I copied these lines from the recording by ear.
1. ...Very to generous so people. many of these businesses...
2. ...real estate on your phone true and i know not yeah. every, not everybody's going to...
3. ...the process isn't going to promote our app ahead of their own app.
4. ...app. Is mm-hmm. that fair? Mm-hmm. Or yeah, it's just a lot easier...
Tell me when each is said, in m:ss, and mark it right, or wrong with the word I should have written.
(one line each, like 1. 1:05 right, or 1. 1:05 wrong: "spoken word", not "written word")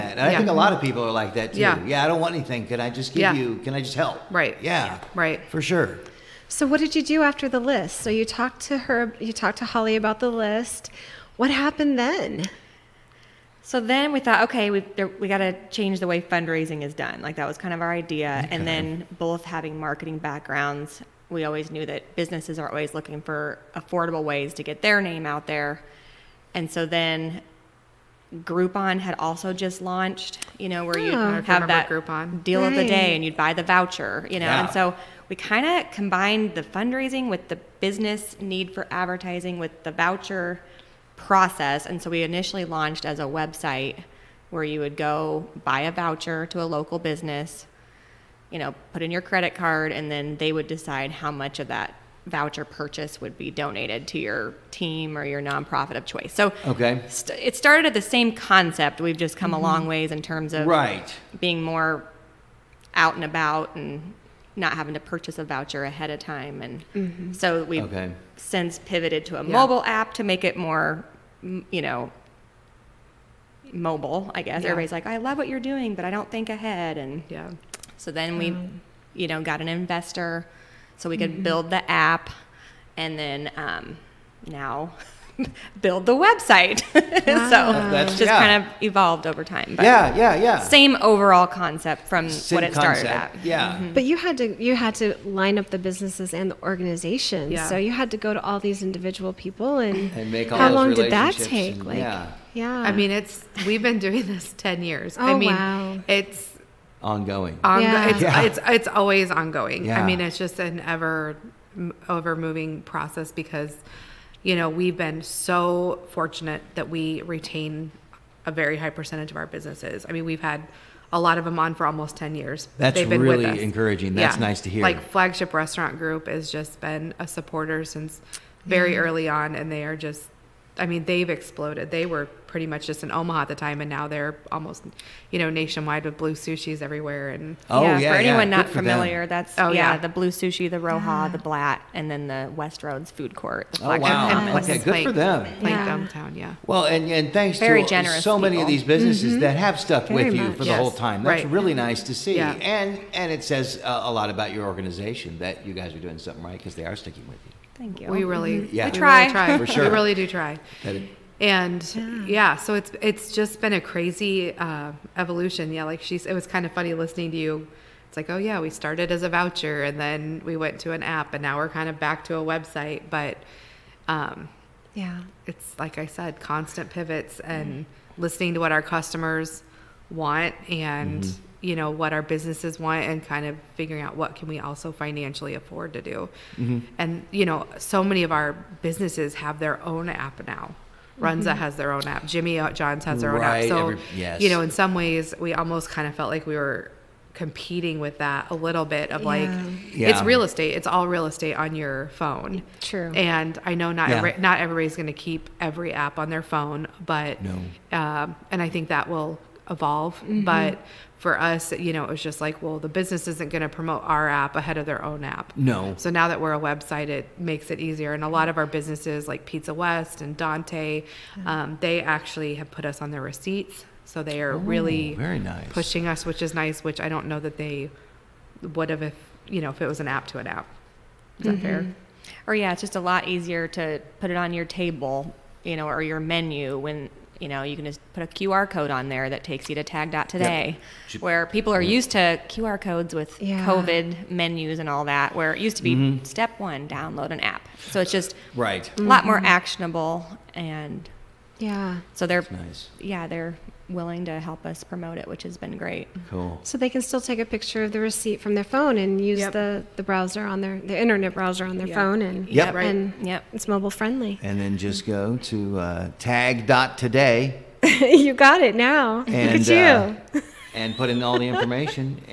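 1. 2:27 right
2. 3:21 right
3. 3:32 wrong: "business", not "process"
4. 3:50 right.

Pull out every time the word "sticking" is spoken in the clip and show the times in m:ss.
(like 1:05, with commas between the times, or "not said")
2:36.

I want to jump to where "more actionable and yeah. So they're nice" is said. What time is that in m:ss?
4:09.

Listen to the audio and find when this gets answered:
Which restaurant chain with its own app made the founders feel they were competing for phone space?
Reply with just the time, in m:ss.
3:11.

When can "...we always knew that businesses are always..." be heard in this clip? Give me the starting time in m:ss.
0:21.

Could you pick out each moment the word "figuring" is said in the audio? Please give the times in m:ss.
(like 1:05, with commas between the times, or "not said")
3:03.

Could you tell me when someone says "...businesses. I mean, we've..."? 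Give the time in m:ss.
1:59.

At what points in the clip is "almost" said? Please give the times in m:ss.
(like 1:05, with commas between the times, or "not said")
2:01, 2:14, 3:15.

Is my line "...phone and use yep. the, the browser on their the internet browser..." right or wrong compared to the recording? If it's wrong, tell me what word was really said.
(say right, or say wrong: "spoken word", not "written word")
right.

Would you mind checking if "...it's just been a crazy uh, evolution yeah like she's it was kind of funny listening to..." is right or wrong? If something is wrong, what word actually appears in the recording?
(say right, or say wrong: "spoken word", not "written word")
right.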